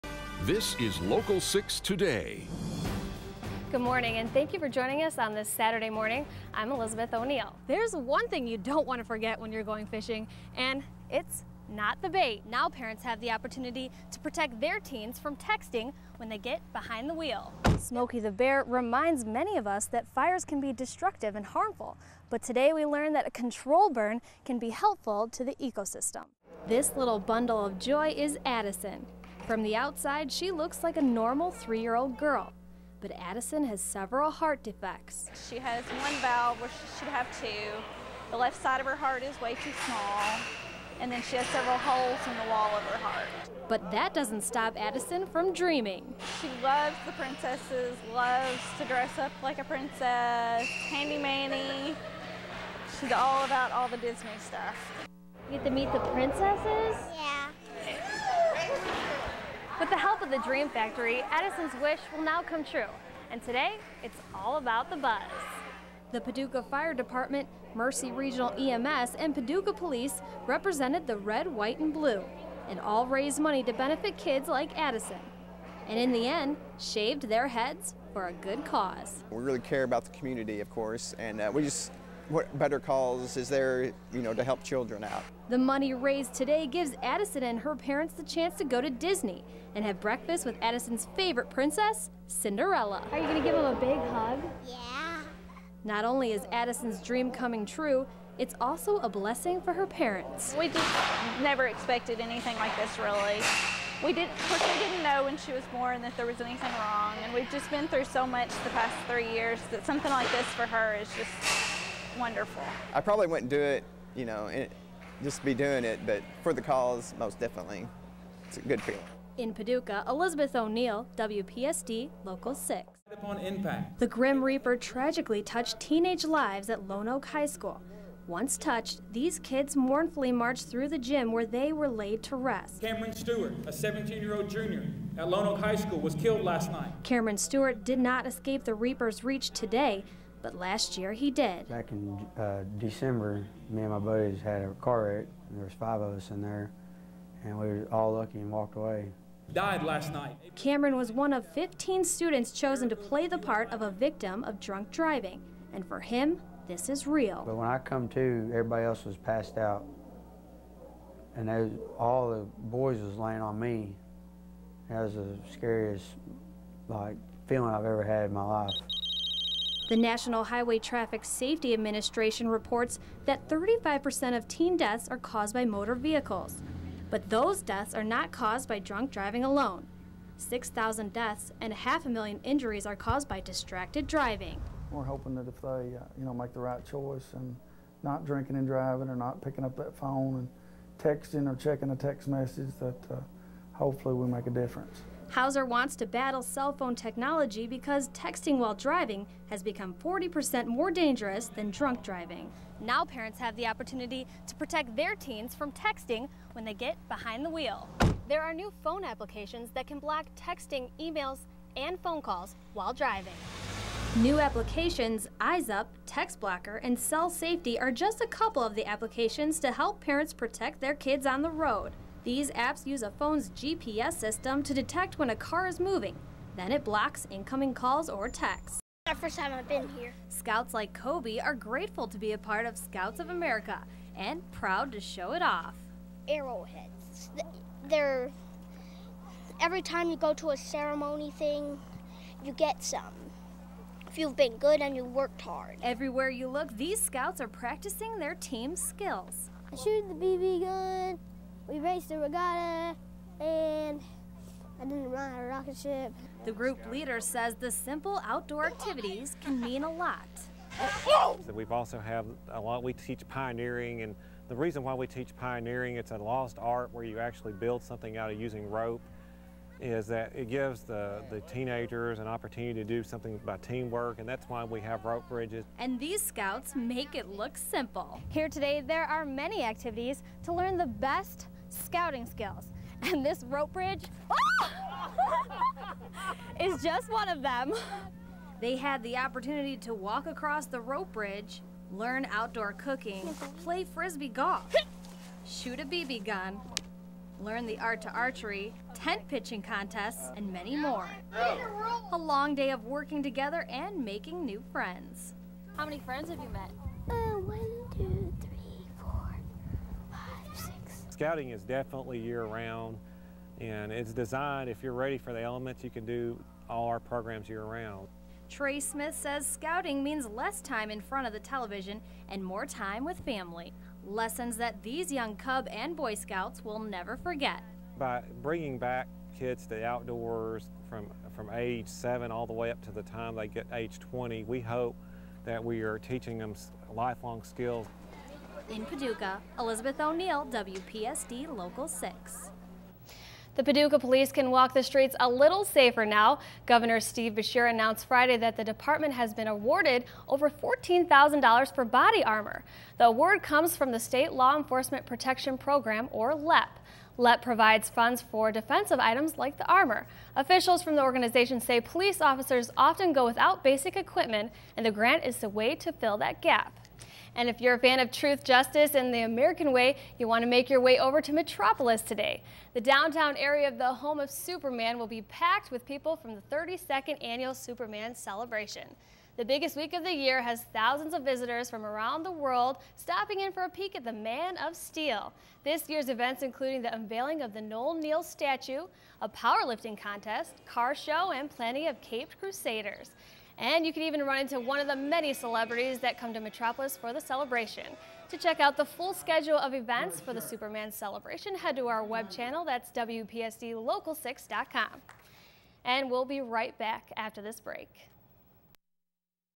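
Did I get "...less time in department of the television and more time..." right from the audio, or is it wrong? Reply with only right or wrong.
wrong.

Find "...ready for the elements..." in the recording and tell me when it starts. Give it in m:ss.
5:14.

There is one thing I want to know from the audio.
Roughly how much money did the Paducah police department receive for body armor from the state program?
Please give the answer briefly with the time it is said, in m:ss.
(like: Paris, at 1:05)
$14,000, at 5:50.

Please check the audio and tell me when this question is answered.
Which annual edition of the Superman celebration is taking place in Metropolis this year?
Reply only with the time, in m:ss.
6:16.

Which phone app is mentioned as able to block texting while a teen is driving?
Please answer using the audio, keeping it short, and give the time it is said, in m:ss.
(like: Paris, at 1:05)
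Eyes Up, at 3:35.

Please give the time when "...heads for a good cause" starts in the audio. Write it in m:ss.
1:17.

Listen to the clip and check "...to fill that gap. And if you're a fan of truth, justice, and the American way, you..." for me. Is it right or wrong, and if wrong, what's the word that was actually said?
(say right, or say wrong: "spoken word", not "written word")
right.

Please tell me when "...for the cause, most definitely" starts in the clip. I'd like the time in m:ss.
1:56.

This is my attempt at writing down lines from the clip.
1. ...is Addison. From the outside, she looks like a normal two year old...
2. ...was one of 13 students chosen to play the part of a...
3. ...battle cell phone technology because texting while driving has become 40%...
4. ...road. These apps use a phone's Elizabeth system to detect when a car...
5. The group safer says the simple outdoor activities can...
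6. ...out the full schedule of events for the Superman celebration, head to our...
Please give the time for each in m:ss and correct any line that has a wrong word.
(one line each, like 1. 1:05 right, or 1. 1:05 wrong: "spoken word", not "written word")
1. 0:28 wrong: "three", not "two"
2. 2:30 wrong: "15", not "13"
3. 3:16 right
4. 3:41 wrong: "GPS", not "Elizabeth"
5. 4:16 wrong: "leader", not "safer"
6. 6:38 right.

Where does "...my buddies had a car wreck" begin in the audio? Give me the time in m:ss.
2:23.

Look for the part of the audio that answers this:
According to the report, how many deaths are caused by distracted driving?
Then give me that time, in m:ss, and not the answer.
3:00.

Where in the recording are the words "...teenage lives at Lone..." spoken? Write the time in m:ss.
2:05.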